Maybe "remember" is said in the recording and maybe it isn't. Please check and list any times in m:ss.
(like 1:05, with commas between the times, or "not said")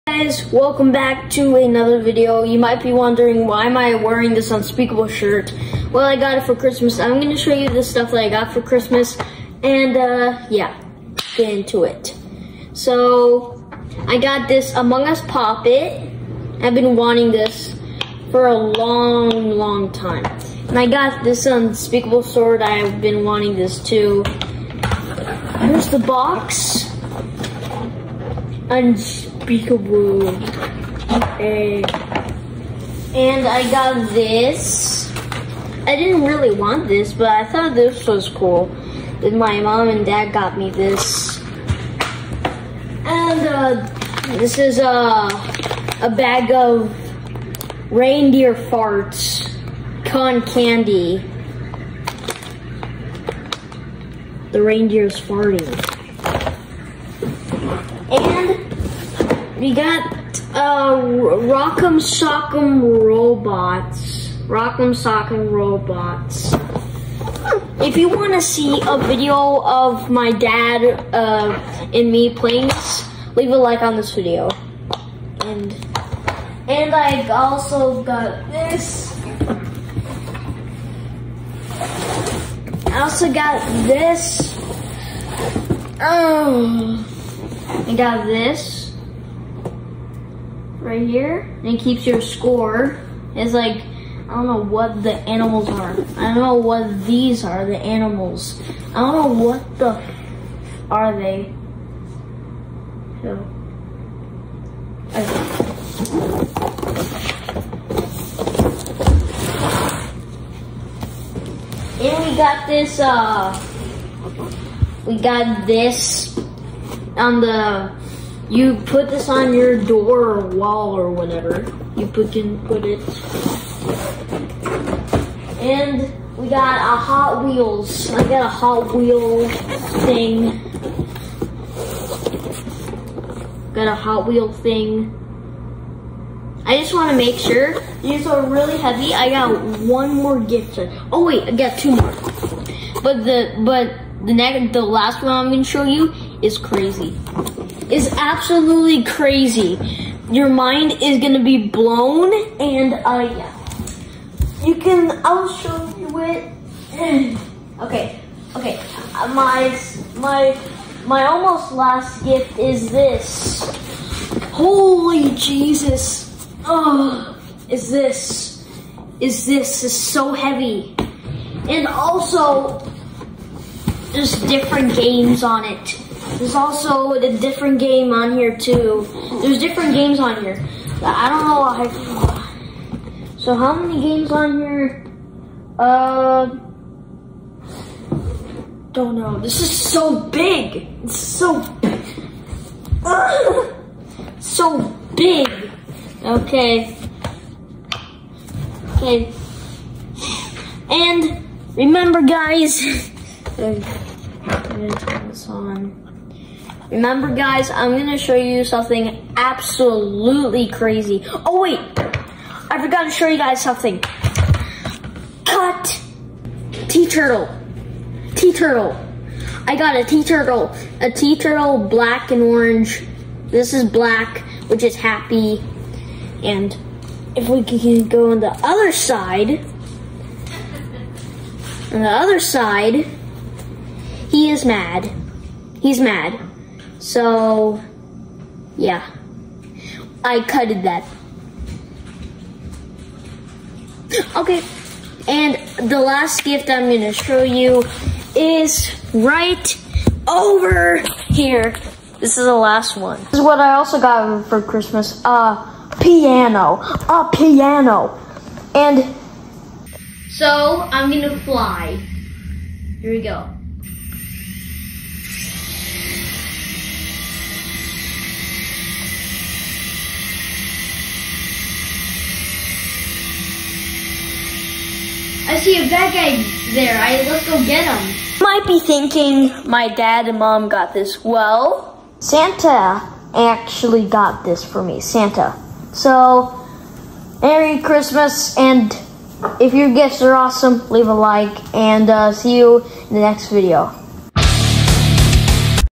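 3:21, 3:26.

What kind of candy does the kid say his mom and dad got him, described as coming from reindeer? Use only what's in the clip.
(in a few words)
Reindeer farts.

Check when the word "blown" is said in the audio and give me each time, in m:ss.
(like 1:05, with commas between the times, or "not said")
2:31.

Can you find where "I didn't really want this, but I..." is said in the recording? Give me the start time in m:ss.
0:35.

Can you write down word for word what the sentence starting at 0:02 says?
You might be wondering why am I wearing this unspeakable shirt?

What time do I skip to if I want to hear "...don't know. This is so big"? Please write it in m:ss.
3:08.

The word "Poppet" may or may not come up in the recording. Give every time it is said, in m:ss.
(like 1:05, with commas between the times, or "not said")
0:15.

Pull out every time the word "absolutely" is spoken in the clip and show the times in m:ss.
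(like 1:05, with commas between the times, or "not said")
2:28, 3:29.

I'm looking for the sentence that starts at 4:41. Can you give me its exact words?
Well, Santa actually got this for me.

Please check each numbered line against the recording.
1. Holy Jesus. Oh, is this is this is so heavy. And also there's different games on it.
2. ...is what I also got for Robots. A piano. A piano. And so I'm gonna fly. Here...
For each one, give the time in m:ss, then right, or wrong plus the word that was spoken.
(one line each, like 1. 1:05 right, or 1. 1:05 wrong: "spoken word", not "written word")
1. 2:44 right
2. 4:13 wrong: "Christmas", not "Robots".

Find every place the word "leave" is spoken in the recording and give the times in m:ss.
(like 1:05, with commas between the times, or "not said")
1:13, 4:50.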